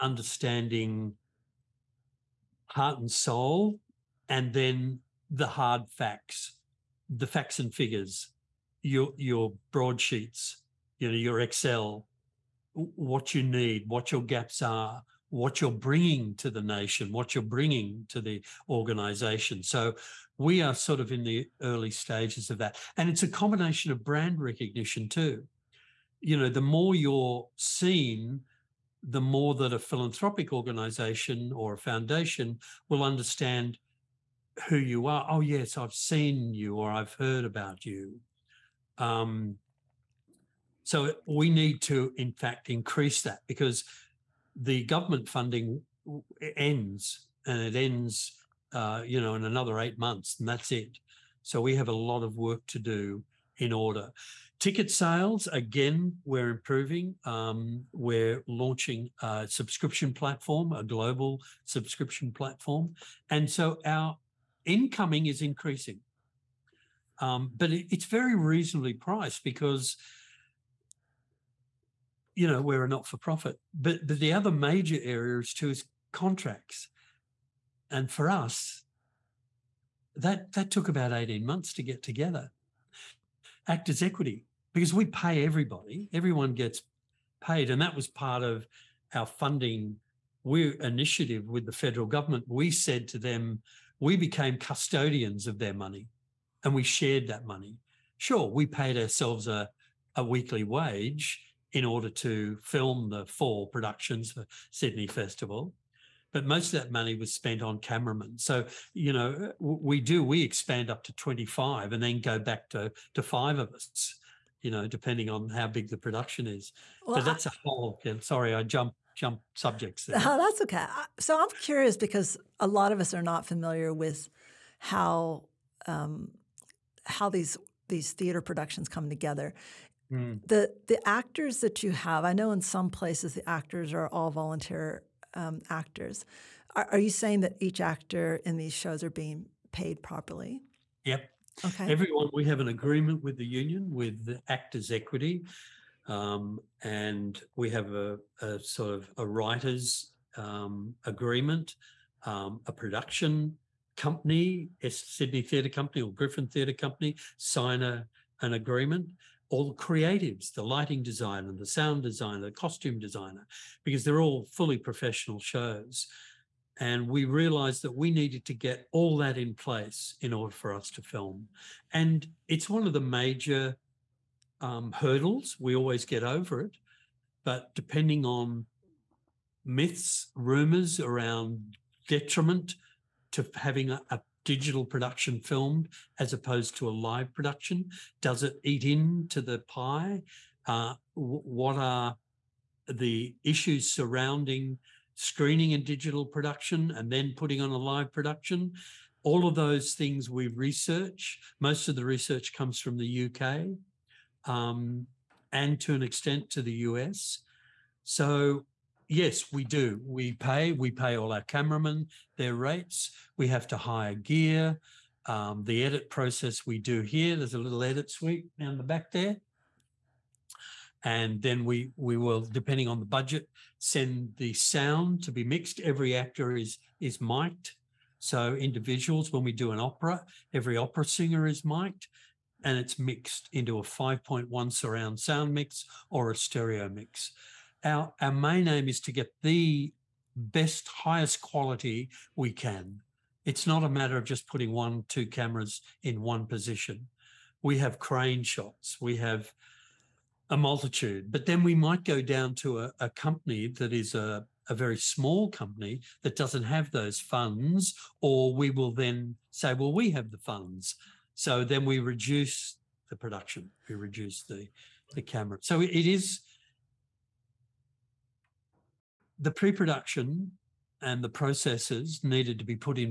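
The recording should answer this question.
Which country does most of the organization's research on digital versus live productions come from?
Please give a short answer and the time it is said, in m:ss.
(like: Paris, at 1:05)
UK, at 3:23.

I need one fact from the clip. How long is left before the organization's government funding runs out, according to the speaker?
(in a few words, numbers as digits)
8 months.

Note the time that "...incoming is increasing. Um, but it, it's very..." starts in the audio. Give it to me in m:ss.
1:04.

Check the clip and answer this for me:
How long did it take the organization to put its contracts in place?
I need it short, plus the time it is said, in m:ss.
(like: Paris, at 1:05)
18 months, at 1:21.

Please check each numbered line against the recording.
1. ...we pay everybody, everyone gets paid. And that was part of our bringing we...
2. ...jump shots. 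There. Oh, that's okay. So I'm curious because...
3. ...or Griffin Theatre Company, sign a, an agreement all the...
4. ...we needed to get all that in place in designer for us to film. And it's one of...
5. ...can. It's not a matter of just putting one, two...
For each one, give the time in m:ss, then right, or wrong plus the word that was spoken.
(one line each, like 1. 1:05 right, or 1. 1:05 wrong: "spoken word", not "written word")
1. 1:24 wrong: "funding", not "bringing"
2. 1:59 wrong: "subjects", not "shots"
3. 2:36 right
4. 2:47 wrong: "order", not "designer"
5. 4:02 right.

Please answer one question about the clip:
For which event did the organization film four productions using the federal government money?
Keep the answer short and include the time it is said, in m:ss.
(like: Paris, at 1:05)
Sydney Festival, at 1:44.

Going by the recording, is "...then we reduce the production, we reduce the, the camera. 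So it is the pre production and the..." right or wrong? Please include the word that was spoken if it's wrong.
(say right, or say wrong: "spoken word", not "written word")
right.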